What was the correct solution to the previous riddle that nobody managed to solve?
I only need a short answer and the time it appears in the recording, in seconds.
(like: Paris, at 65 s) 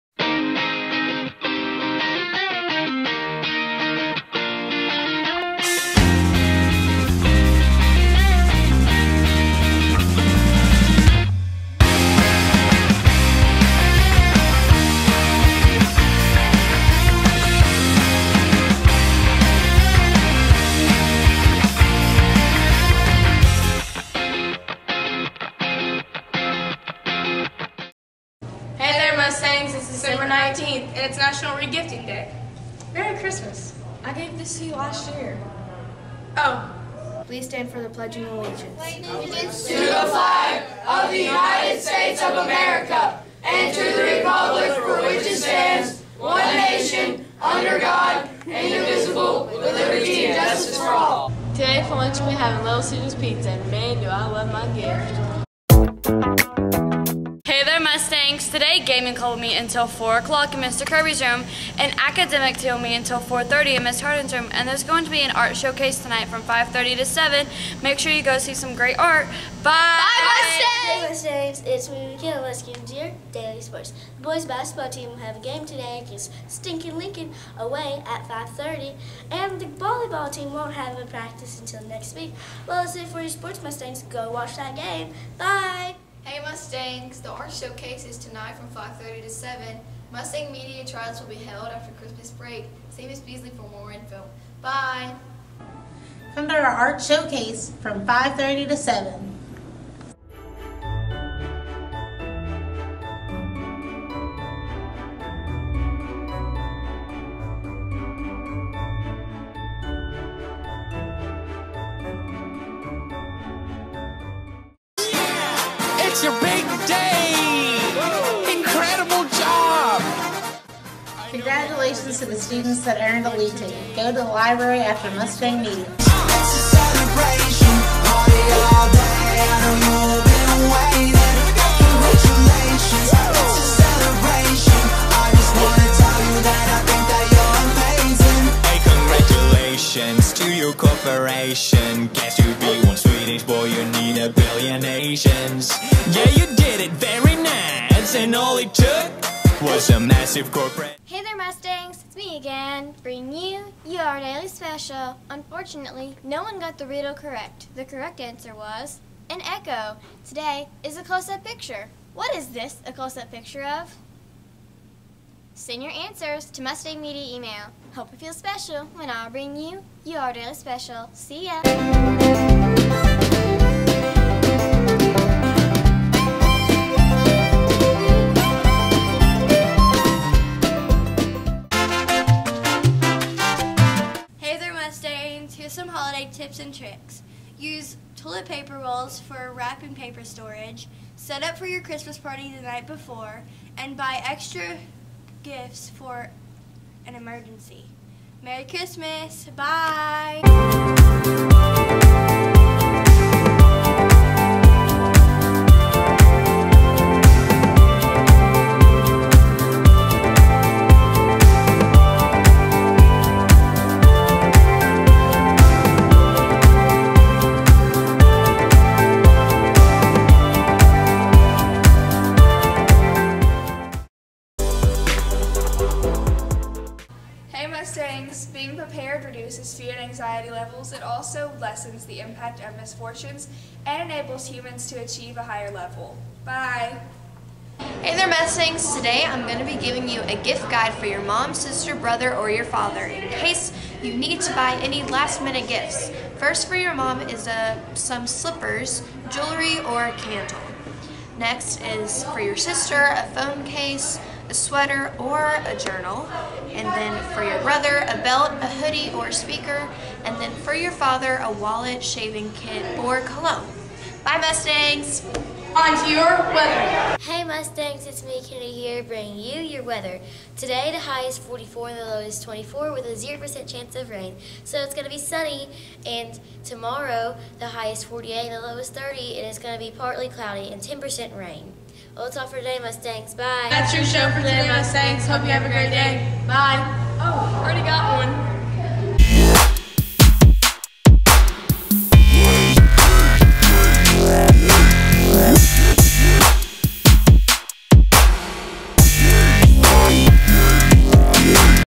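an echo, at 159 s.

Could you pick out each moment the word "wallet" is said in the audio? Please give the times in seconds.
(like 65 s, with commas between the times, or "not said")
261 s.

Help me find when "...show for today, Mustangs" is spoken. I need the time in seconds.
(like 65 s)
284 s.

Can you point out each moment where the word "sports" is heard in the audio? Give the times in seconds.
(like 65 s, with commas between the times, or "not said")
73 s, 83 s.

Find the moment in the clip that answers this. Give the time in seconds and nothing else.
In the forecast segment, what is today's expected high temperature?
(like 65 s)
271 s.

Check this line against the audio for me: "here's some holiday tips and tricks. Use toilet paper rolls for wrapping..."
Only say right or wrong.
right.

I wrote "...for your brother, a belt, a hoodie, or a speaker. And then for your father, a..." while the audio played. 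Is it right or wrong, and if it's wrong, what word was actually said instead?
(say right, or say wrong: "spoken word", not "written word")
right.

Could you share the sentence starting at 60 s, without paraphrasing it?
Kirby's room, and academic told me until 4.30 in Ms.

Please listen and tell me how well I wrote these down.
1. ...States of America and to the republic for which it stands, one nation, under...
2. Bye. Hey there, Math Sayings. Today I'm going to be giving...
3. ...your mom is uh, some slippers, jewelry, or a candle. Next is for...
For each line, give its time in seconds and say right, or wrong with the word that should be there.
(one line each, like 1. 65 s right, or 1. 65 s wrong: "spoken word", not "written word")
1. 41 s right
2. 236 s right
3. 246 s right.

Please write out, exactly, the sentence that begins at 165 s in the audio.
Send your answers to Mustang Media email.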